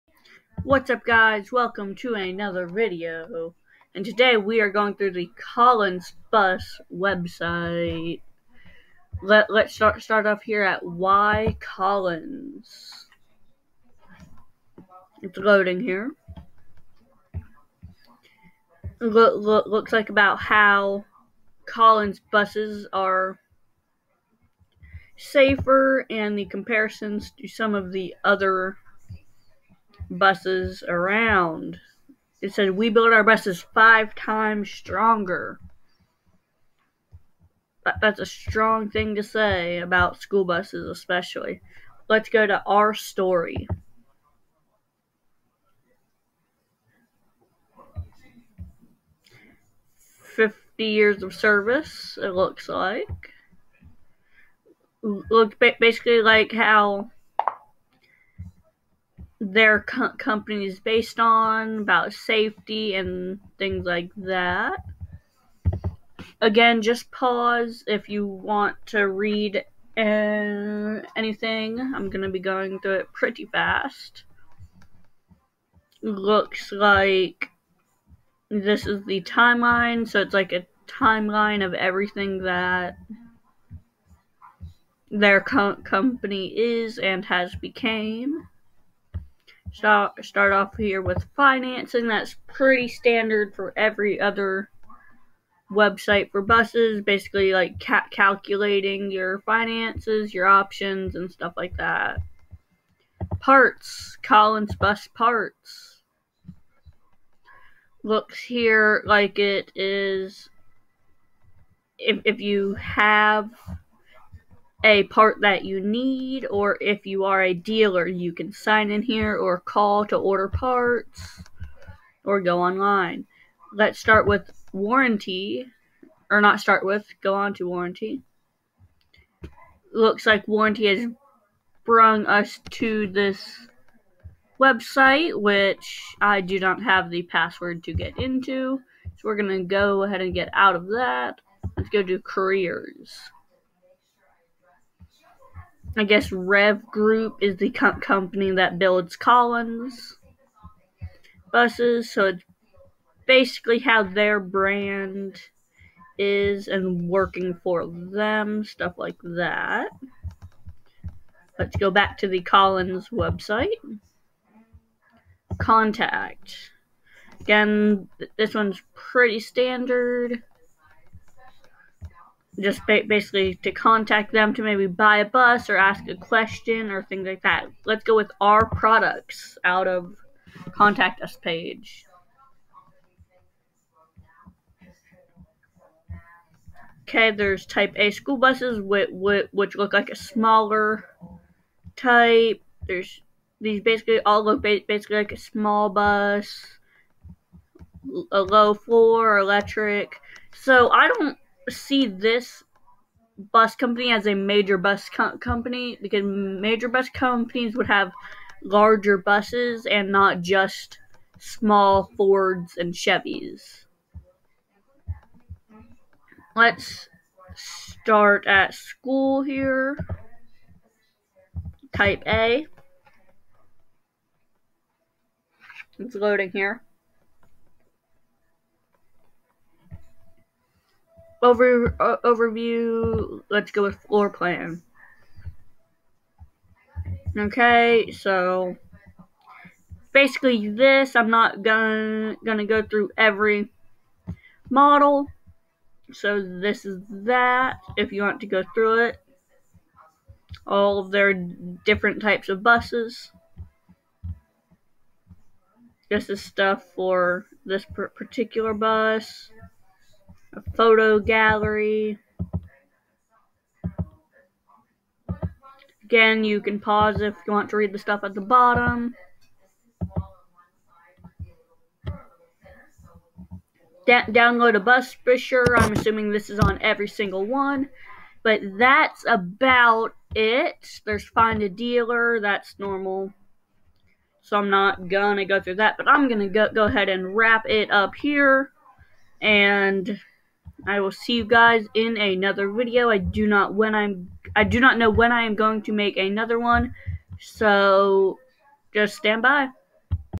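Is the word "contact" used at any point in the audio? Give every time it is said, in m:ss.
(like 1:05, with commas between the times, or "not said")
2:45, 2:53, 3:00.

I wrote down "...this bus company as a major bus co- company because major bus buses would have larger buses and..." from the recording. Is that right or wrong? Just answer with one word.
wrong.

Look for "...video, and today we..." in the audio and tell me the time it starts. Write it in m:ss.
0:02.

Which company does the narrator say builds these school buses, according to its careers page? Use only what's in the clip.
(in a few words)
Rev Group.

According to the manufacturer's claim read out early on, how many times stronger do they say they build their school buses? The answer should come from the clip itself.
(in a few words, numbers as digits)
5.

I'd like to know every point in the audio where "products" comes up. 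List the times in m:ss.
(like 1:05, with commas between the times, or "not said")
2:58.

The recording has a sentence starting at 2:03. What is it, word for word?
Let's start with warranty, or not start with, go on to warranty.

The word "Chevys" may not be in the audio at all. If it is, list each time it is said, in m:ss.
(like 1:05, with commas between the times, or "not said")
3:32.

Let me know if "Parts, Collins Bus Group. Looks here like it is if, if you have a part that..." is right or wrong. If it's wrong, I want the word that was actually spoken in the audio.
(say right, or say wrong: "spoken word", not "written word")
wrong: "Parts", not "Group".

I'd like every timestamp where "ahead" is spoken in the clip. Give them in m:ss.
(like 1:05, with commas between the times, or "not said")
2:20, 4:46.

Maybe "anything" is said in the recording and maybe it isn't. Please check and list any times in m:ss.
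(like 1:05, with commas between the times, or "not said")
1:11.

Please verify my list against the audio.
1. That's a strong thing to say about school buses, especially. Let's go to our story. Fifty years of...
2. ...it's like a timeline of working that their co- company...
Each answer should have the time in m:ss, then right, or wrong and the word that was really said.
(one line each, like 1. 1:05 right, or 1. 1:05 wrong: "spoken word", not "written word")
1. 0:38 right
2. 1:20 wrong: "everything", not "working".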